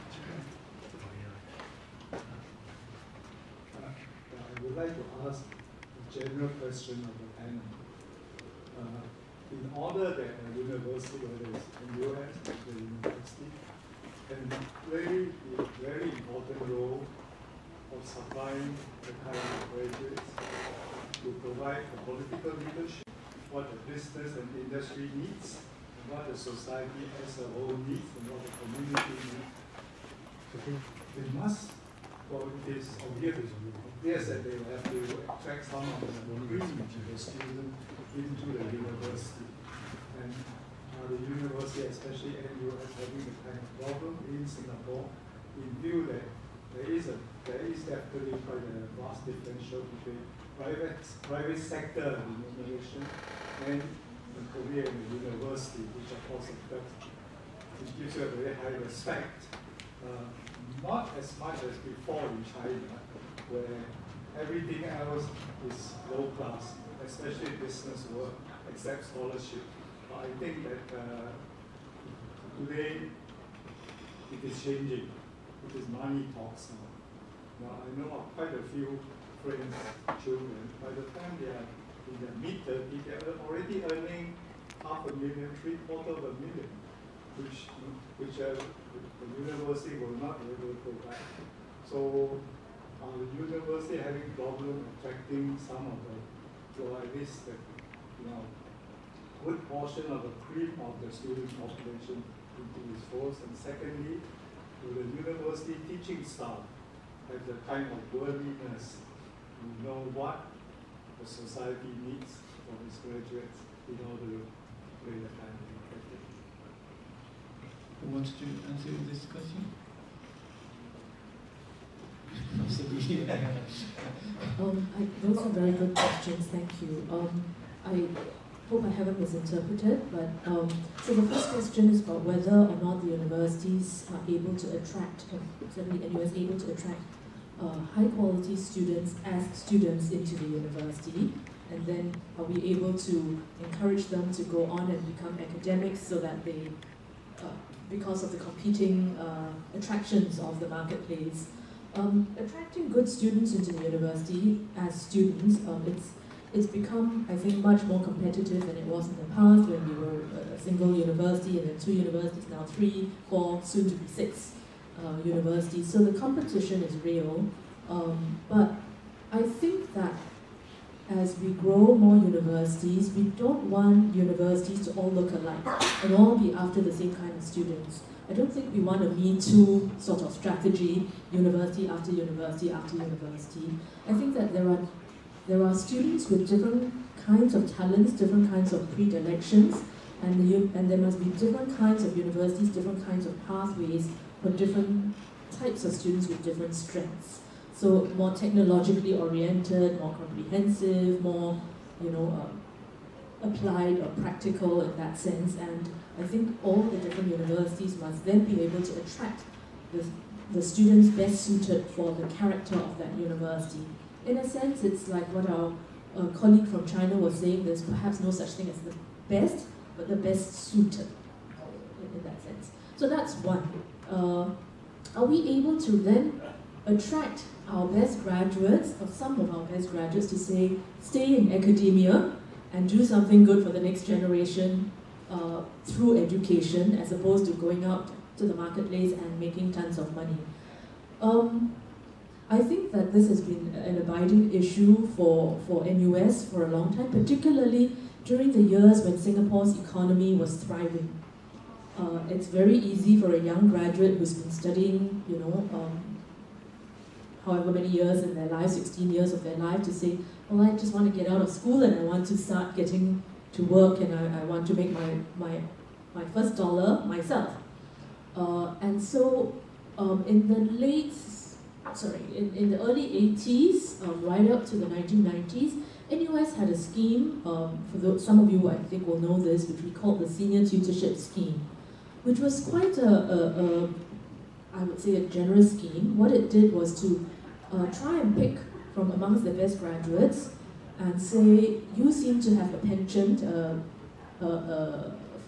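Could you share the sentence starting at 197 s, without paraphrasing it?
So more technologically oriented, more comprehensive, more, you know, uh, applied or practical in that sense.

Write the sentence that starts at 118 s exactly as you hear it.
Who wants to answer this question?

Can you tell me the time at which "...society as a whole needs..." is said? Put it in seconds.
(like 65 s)
26 s.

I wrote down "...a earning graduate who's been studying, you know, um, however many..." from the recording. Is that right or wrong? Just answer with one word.
wrong.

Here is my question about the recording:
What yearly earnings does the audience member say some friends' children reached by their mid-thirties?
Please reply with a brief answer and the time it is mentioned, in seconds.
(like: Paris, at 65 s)
half a million, at 84 s.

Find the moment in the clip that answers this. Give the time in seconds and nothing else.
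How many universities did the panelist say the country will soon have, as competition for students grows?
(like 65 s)
164 s.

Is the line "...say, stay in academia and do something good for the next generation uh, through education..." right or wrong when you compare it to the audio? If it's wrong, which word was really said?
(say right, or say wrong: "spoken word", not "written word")
right.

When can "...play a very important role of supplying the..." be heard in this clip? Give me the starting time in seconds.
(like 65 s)
14 s.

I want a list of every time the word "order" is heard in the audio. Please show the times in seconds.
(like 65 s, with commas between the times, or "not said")
9 s, 114 s.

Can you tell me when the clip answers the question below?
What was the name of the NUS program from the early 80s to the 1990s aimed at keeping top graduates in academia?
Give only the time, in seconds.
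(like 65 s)
280 s.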